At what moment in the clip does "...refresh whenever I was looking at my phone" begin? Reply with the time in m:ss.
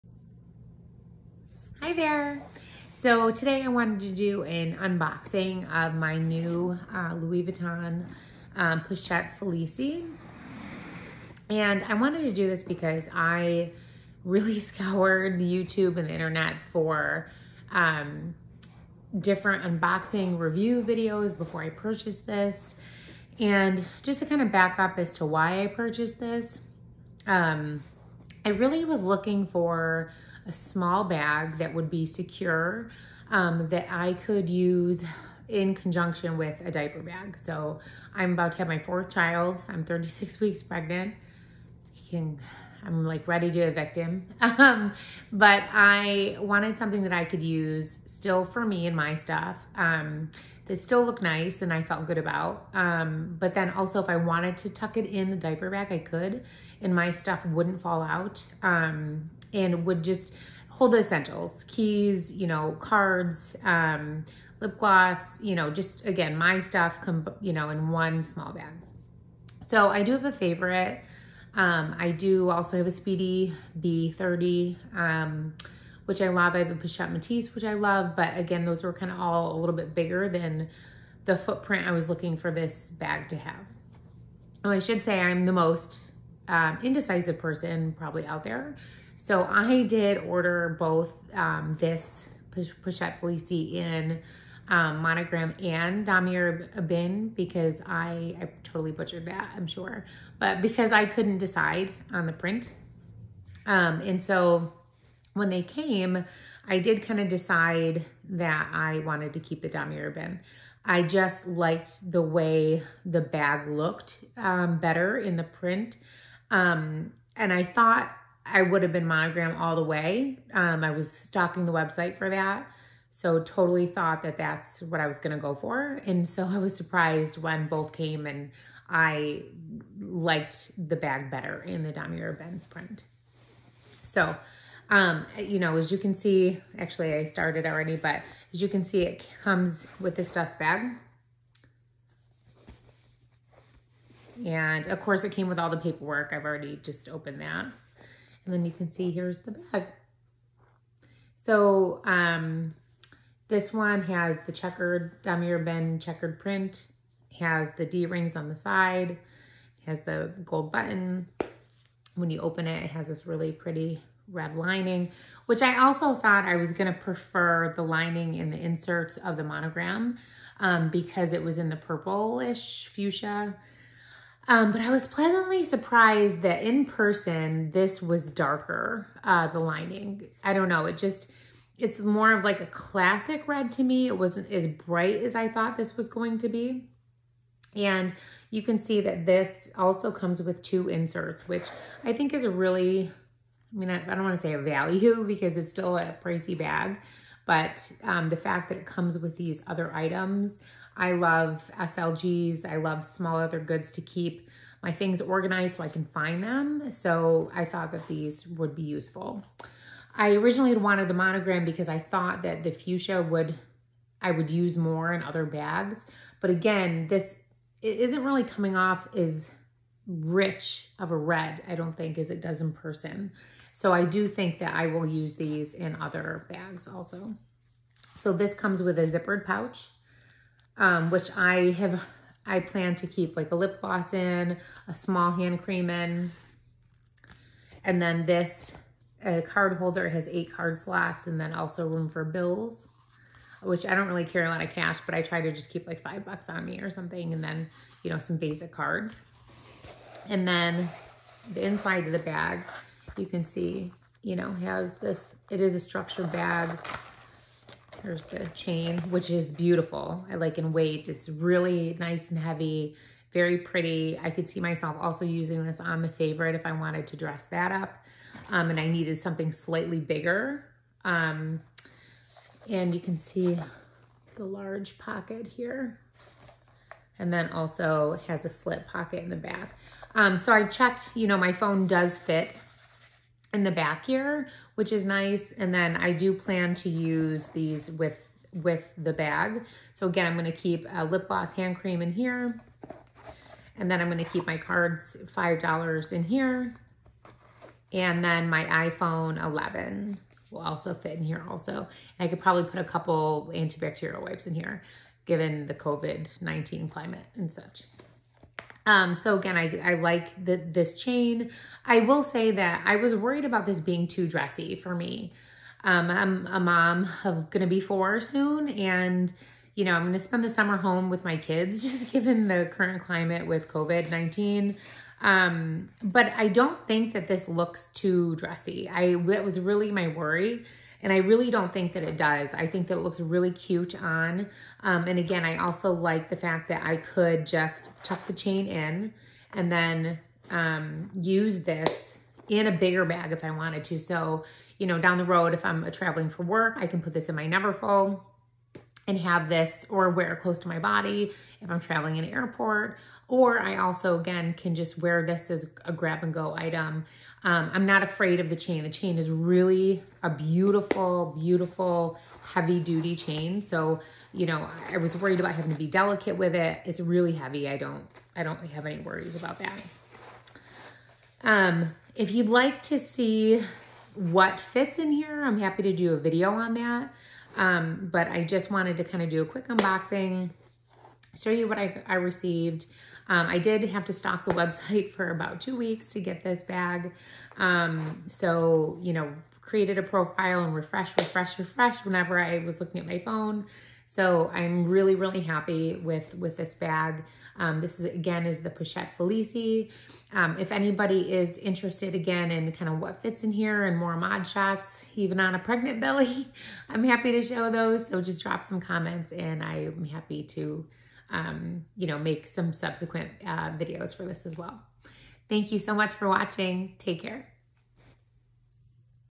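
6:31.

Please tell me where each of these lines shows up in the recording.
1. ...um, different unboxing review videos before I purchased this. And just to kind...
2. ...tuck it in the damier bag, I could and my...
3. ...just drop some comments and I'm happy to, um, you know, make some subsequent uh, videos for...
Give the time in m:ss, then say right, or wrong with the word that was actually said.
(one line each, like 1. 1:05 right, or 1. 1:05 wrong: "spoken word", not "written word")
1. 0:17 right
2. 0:54 wrong: "diaper", not "damier"
3. 6:48 right.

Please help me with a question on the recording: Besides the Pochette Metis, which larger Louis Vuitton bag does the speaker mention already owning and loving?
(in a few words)
Speedy B30.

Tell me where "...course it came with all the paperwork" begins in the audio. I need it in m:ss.
2:25.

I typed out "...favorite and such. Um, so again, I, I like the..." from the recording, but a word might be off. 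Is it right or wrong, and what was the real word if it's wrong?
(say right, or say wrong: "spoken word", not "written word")
wrong: "climate", not "favorite".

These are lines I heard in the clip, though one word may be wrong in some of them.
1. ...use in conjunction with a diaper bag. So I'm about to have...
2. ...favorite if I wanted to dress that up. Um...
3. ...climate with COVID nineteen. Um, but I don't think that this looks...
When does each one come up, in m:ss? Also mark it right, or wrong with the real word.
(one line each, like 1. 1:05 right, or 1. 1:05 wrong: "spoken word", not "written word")
1. 0:34 right
2. 4:26 right
3. 5:23 right.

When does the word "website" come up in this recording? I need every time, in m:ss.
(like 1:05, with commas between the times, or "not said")
2:01, 6:24.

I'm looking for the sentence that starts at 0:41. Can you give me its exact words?
He can, I'm like ready to evict him.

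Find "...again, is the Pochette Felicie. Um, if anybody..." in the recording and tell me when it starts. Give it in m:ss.
6:38.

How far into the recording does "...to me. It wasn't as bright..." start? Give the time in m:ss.
3:03.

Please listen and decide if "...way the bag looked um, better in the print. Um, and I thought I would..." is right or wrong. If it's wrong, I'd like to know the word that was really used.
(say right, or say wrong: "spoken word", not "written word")
right.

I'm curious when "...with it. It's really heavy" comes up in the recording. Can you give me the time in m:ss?
6:06.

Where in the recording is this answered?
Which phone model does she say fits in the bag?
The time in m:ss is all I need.
4:58.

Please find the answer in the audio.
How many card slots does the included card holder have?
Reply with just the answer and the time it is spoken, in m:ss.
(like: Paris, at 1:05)
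8, at 4:00.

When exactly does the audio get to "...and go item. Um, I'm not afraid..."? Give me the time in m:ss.
5:56.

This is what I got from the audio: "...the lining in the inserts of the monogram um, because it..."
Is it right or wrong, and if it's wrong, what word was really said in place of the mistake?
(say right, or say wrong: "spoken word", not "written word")
right.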